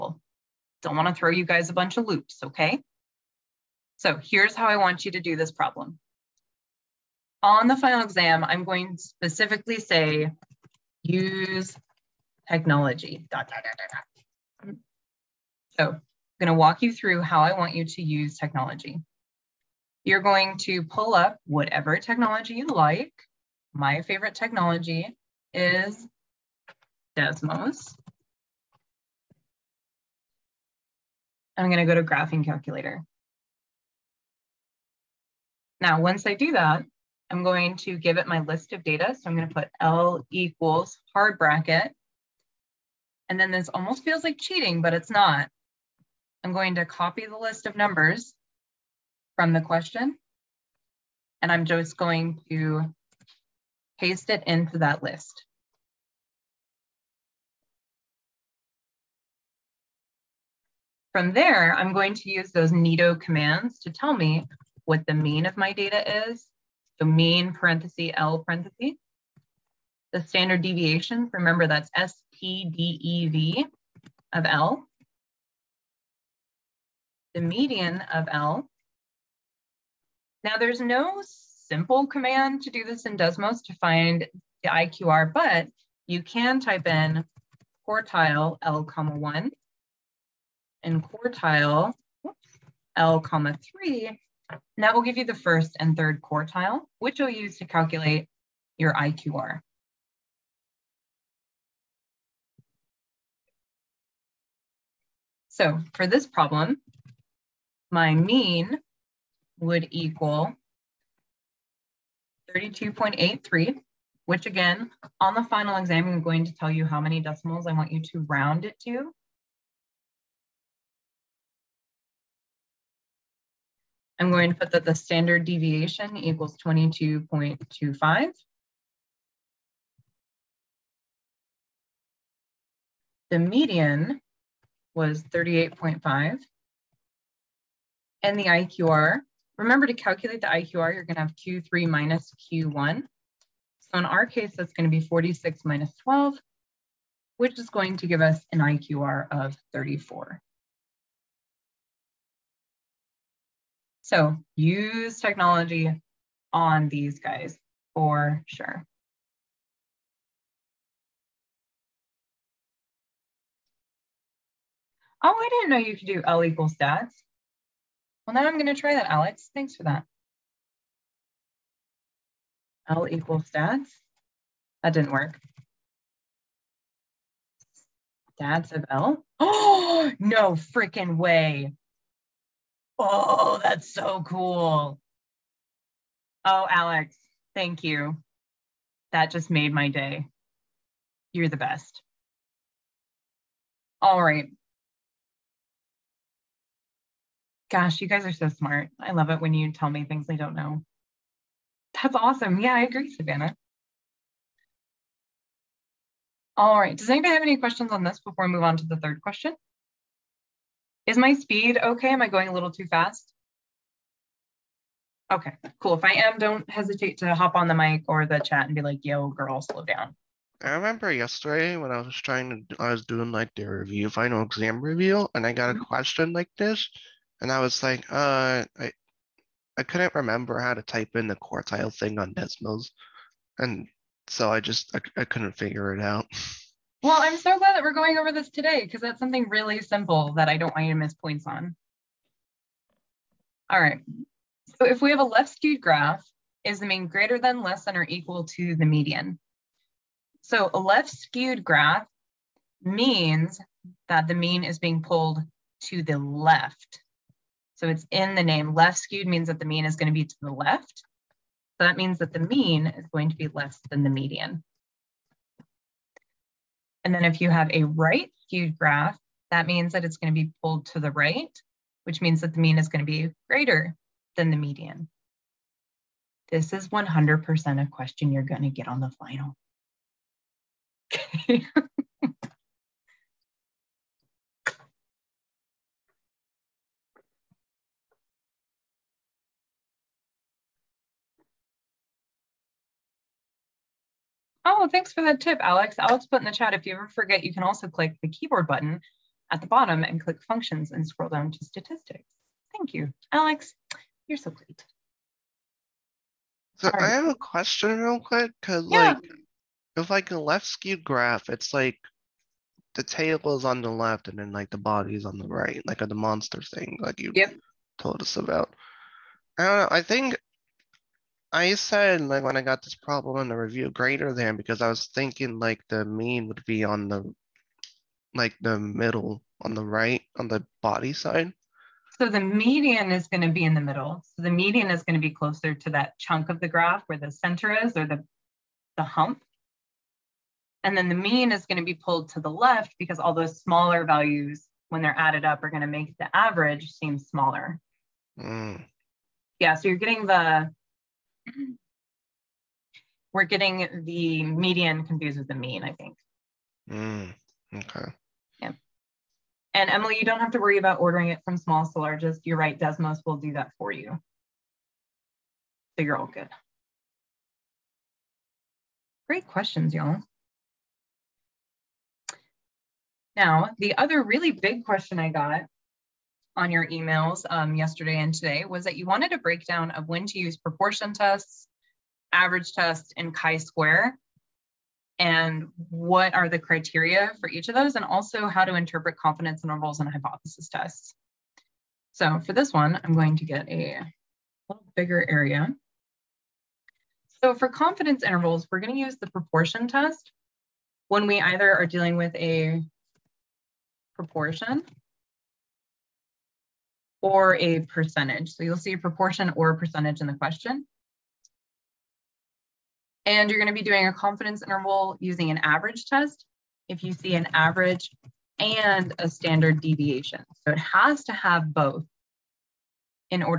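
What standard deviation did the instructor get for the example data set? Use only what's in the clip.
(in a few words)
22.25.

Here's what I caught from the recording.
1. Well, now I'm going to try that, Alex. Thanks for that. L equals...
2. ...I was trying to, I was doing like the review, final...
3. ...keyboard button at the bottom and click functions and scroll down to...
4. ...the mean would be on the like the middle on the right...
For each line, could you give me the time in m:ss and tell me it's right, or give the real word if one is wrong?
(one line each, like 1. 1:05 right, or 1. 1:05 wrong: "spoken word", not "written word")
1. 2:48 right
2. 3:41 right
3. 4:58 right
4. 5:25 right.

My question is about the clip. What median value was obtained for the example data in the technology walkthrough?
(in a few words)
38.5.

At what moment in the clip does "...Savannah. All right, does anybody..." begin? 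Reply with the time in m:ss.
3:23.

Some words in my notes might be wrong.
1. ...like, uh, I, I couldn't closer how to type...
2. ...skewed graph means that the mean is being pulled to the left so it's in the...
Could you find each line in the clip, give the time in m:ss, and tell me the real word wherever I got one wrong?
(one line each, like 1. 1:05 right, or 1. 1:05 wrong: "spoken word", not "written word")
1. 3:47 wrong: "remember", not "closer"
2. 4:11 right.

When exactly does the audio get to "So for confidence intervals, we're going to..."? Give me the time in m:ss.
6:37.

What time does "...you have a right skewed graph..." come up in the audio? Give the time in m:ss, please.
4:27.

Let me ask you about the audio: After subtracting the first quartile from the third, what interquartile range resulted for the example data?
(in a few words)
34.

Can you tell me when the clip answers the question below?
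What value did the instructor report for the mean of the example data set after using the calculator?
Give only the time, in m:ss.
1:52.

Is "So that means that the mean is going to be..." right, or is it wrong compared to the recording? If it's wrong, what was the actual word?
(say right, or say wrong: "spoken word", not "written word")
right.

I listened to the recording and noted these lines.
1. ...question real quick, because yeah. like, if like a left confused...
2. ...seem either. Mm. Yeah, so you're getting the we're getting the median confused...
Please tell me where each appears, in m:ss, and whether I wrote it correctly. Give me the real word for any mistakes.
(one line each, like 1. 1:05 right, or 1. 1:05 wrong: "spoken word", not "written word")
1. 5:07 wrong: "skewed", not "confused"
2. 5:46 wrong: "smaller", not "either".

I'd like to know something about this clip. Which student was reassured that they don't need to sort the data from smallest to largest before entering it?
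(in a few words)
Emily.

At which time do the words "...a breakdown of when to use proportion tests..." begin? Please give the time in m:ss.
6:19.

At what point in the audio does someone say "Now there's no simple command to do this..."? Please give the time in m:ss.
1:20.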